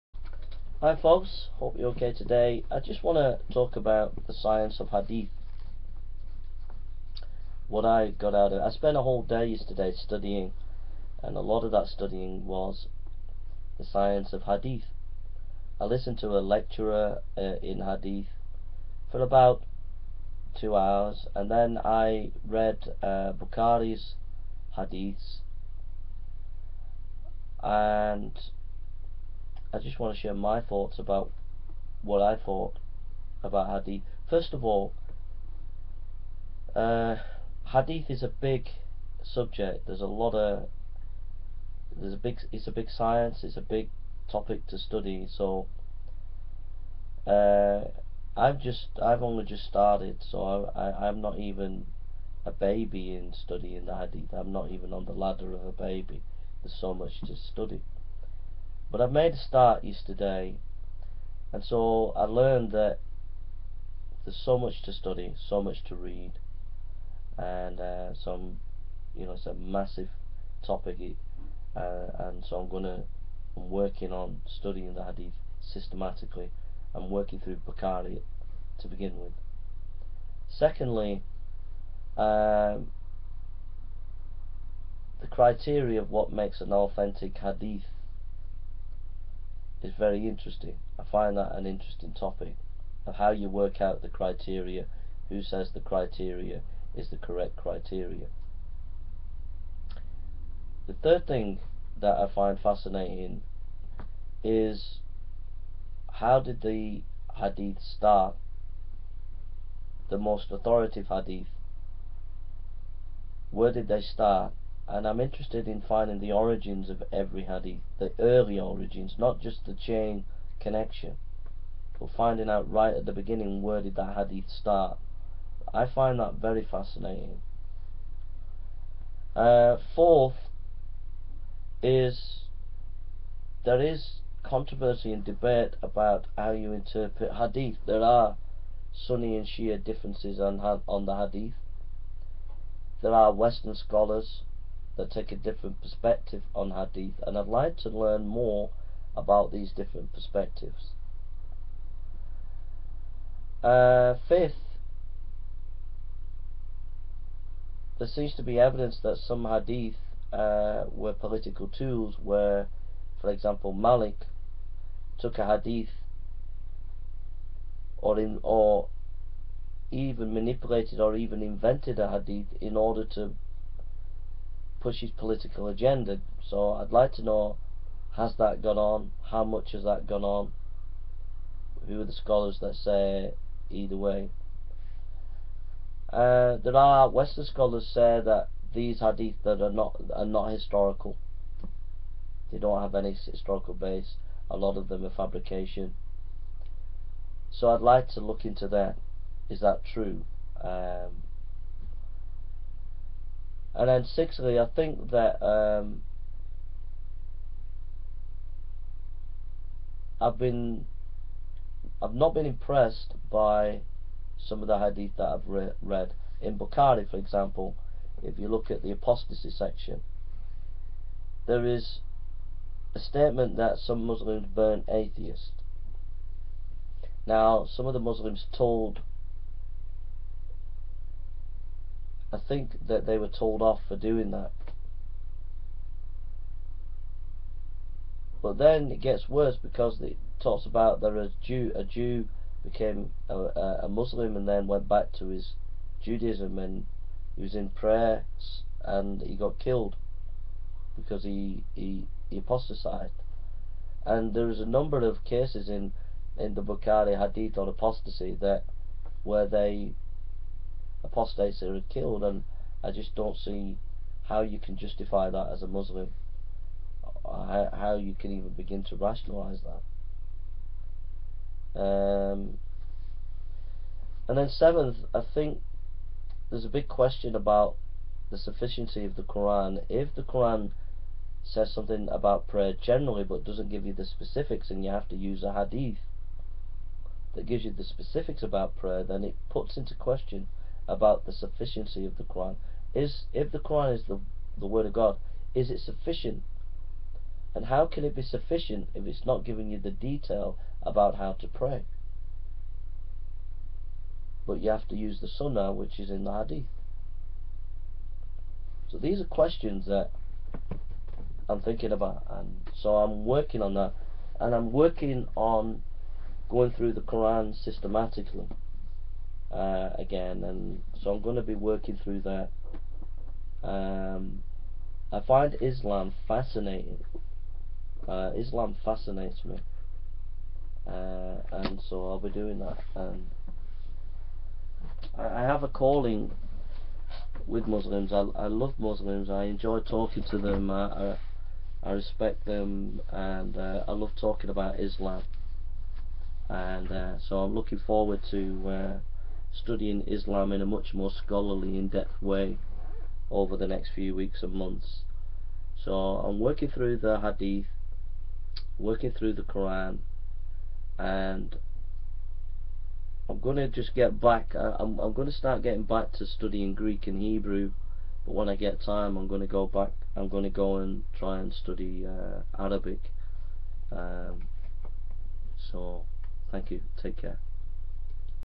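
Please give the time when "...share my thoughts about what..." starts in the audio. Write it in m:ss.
0:30.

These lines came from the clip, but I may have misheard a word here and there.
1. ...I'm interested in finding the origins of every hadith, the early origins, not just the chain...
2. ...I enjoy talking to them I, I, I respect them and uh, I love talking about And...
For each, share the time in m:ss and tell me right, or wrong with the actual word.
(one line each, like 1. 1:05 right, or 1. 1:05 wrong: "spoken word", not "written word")
1. 1:55 right
2. 5:39 wrong: "Islam", not "And".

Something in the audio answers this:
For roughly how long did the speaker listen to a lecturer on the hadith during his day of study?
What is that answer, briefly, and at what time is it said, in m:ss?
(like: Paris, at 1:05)
2 hours, at 0:19.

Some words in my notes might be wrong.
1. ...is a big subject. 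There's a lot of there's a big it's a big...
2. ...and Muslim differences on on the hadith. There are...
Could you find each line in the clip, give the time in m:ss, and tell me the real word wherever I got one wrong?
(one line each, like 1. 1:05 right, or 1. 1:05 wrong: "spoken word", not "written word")
1. 0:38 right
2. 2:19 wrong: "Shia", not "Muslim".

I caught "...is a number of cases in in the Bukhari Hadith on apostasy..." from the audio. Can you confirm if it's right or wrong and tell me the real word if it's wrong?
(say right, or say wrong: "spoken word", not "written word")
right.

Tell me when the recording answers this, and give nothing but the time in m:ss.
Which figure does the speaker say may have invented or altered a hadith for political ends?
2:43.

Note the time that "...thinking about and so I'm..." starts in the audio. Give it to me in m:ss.
5:11.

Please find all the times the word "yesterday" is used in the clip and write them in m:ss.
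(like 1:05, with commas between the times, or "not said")
0:09, 0:59.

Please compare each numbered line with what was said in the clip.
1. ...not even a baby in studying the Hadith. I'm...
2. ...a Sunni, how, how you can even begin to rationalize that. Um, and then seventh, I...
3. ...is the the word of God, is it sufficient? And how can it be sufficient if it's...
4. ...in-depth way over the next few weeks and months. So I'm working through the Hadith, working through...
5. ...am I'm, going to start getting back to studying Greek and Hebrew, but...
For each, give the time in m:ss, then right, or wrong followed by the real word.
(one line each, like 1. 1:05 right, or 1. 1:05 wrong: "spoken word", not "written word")
1. 0:51 right
2. 4:25 wrong: "Muslim", not "Sunni"
3. 4:53 right
4. 5:51 right
5. 6:04 right.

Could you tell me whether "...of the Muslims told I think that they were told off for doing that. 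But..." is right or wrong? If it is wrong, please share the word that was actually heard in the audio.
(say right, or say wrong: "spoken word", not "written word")
right.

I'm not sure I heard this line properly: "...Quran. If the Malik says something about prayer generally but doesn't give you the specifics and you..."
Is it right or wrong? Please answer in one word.
wrong.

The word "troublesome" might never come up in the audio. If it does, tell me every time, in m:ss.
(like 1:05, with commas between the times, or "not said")
not said.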